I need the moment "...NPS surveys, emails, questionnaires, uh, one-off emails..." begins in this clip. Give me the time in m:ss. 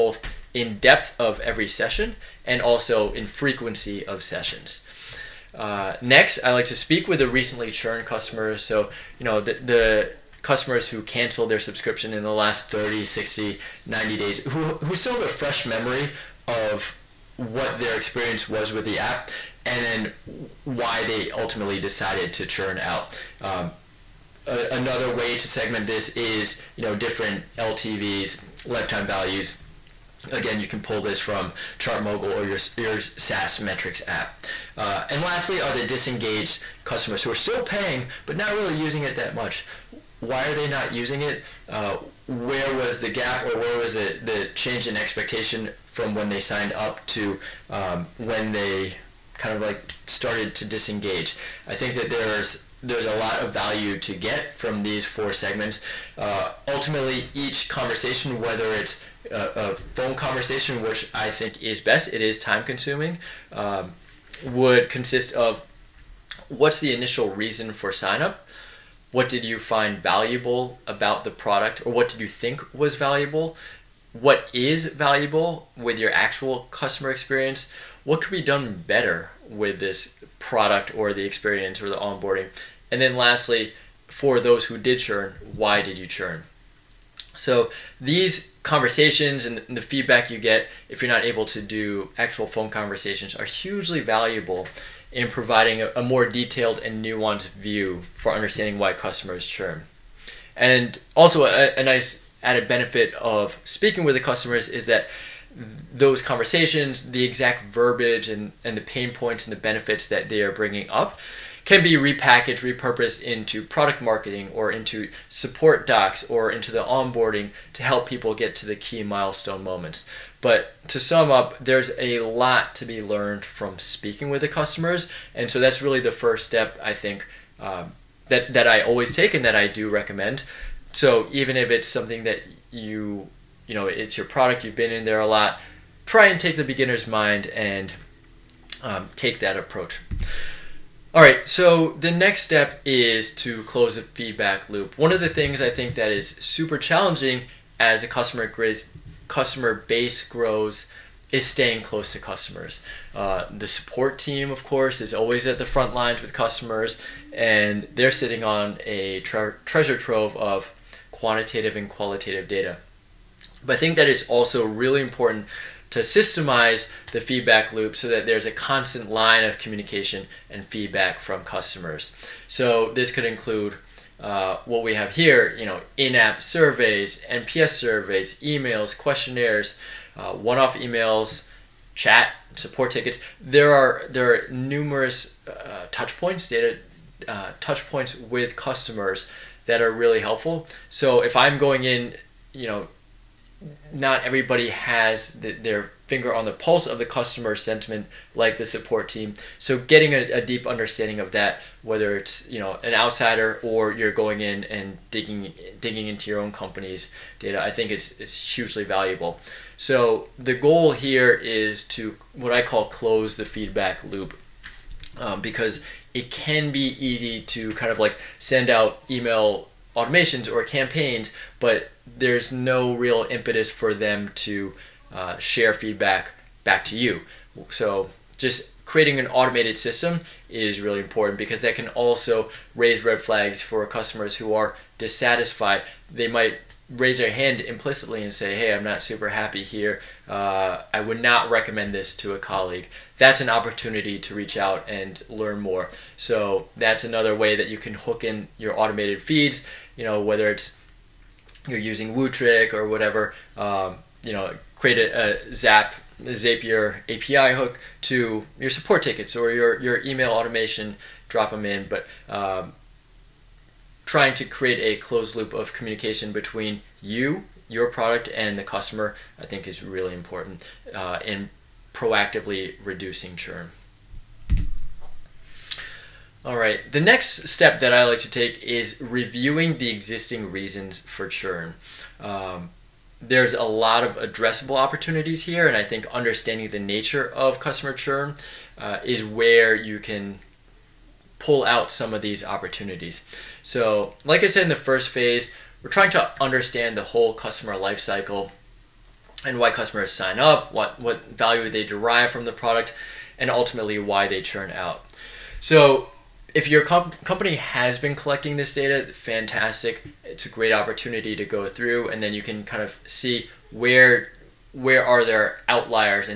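2:57.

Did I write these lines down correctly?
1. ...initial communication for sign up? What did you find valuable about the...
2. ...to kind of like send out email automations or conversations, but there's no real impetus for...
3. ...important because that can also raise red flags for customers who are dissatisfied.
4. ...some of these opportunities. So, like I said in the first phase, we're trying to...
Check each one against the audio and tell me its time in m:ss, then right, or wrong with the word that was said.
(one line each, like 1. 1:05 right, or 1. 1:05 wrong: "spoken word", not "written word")
1. 1:06 wrong: "reason", not "communication"
2. 3:37 wrong: "campaigns", not "conversations"
3. 3:50 right
4. 4:51 right.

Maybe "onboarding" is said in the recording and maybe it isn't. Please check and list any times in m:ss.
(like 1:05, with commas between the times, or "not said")
1:21, 1:56.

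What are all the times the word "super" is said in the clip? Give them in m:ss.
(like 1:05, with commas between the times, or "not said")
2:26, 3:59.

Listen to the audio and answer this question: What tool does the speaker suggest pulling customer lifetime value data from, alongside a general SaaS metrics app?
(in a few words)
ChartMogul.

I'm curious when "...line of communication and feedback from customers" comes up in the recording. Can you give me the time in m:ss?
2:49.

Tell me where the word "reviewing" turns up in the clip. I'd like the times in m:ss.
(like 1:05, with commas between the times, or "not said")
4:38.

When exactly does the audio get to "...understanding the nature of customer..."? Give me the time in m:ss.
4:46.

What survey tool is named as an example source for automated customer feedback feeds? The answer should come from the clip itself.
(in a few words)
Wootric.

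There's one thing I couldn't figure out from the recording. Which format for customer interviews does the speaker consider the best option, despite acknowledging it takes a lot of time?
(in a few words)
Phone conversation.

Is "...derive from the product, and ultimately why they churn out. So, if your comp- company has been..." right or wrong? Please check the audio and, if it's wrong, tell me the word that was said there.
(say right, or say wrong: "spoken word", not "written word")
right.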